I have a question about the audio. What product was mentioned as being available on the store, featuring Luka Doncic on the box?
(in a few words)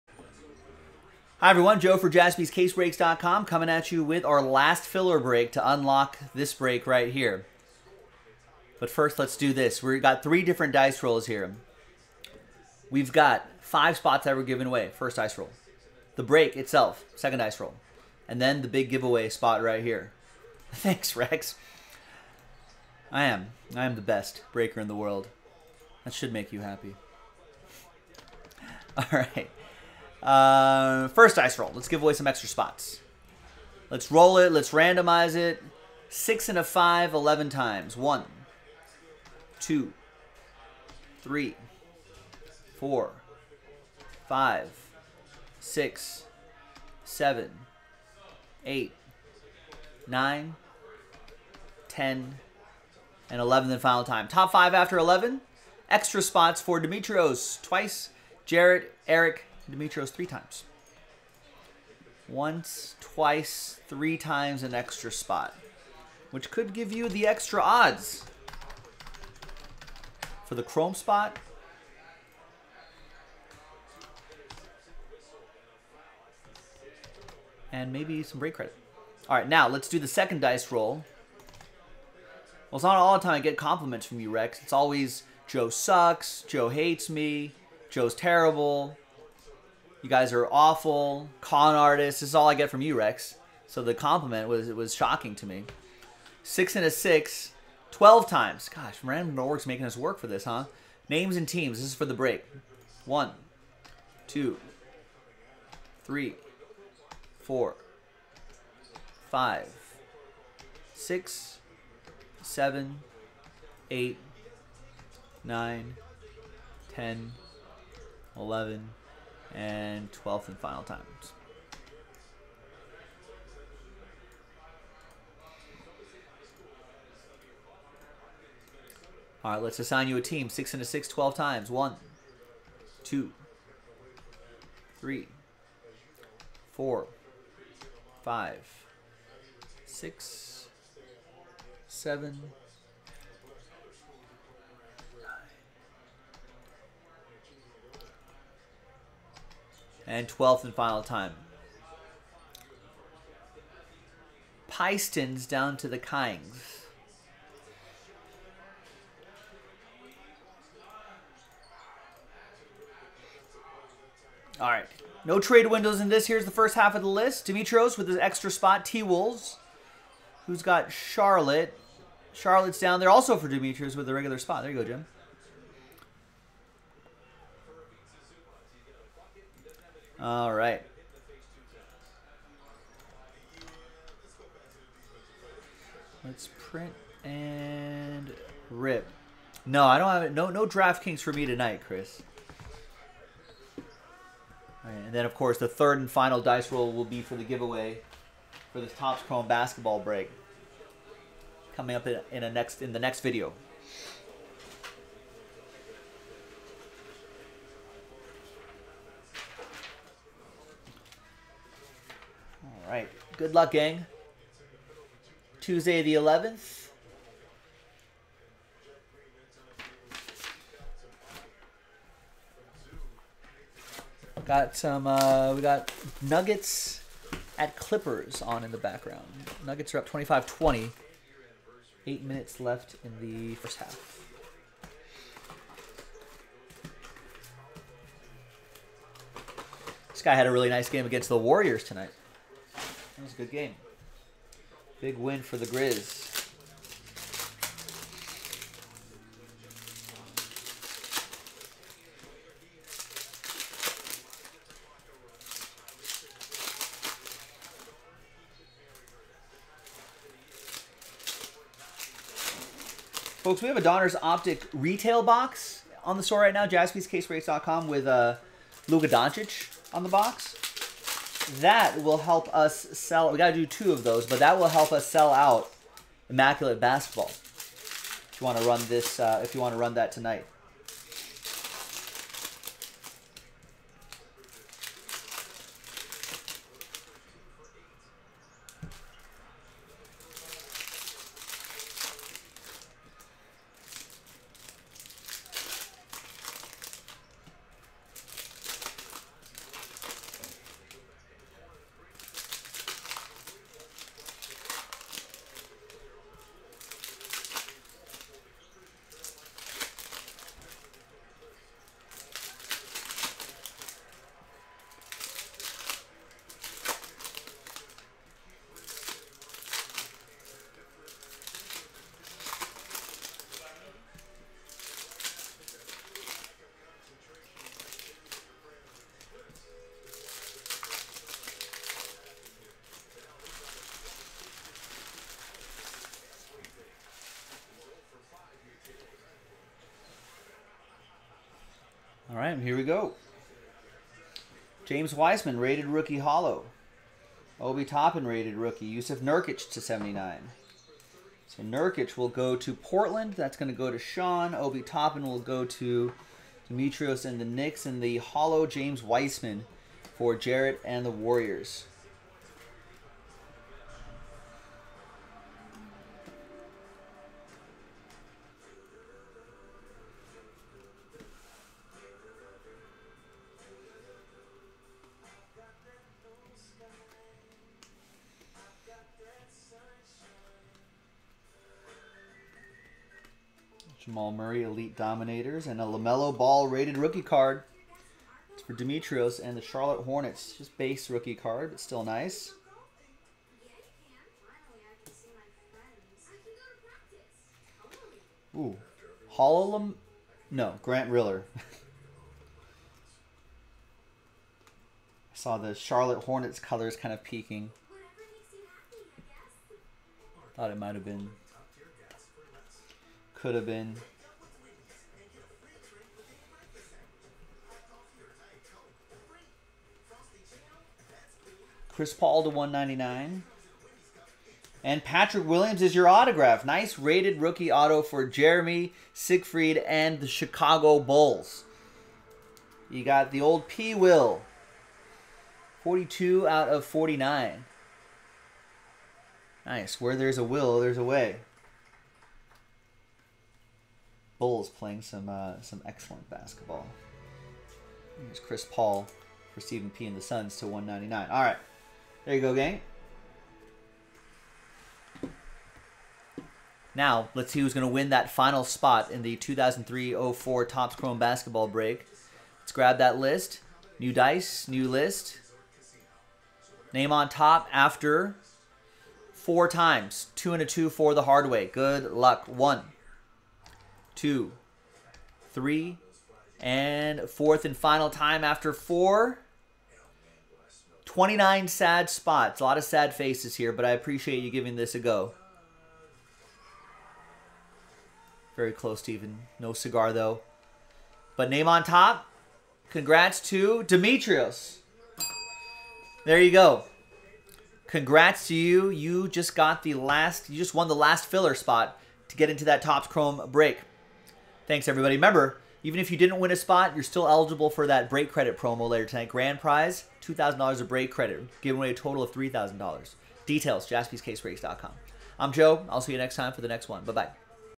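Donruss Optic retail box.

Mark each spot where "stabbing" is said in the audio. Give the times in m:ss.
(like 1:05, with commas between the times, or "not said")
not said.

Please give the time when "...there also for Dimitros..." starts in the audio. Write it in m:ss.
2:52.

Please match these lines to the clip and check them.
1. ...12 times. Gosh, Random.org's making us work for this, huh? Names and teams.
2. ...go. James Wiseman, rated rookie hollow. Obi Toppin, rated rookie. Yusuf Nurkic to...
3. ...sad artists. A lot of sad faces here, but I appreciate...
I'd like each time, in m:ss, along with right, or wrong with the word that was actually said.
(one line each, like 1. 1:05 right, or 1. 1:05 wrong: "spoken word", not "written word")
1. 1:37 right
2. 5:42 right
3. 8:01 wrong: "spots", not "artists".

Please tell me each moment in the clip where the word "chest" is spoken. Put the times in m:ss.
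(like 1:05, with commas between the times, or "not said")
not said.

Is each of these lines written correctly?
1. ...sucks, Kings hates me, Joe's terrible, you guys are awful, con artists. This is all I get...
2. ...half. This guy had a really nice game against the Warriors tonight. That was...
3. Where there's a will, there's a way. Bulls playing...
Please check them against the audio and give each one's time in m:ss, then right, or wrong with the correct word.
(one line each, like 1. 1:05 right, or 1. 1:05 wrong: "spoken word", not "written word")
1. 1:25 wrong: "Joe", not "Kings"
2. 3:53 right
3. 7:19 right.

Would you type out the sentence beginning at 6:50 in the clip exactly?
Thought it might have been could have been.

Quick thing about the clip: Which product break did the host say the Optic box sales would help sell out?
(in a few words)
Immaculate Basketball.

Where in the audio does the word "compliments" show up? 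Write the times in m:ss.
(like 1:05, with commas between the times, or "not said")
1:23, 1:33.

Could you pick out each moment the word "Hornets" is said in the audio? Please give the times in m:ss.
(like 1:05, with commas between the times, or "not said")
6:30, 6:46.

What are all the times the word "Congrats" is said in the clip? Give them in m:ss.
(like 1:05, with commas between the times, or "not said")
8:12, 8:17.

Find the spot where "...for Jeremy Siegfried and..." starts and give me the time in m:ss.
7:08.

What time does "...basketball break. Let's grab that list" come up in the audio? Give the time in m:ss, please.
7:41.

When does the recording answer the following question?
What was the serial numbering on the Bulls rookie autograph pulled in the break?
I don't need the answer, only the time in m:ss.
7:15.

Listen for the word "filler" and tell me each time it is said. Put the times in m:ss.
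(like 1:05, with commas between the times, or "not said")
0:04, 8:21.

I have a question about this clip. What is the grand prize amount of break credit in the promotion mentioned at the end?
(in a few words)
$2,000.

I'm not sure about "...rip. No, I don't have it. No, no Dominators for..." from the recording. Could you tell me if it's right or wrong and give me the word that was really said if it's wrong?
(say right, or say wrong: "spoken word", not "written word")
wrong: "DraftKings", not "Dominators".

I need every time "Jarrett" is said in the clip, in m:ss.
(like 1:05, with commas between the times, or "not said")
0:58, 6:00.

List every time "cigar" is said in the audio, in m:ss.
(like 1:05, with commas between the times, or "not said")
8:09.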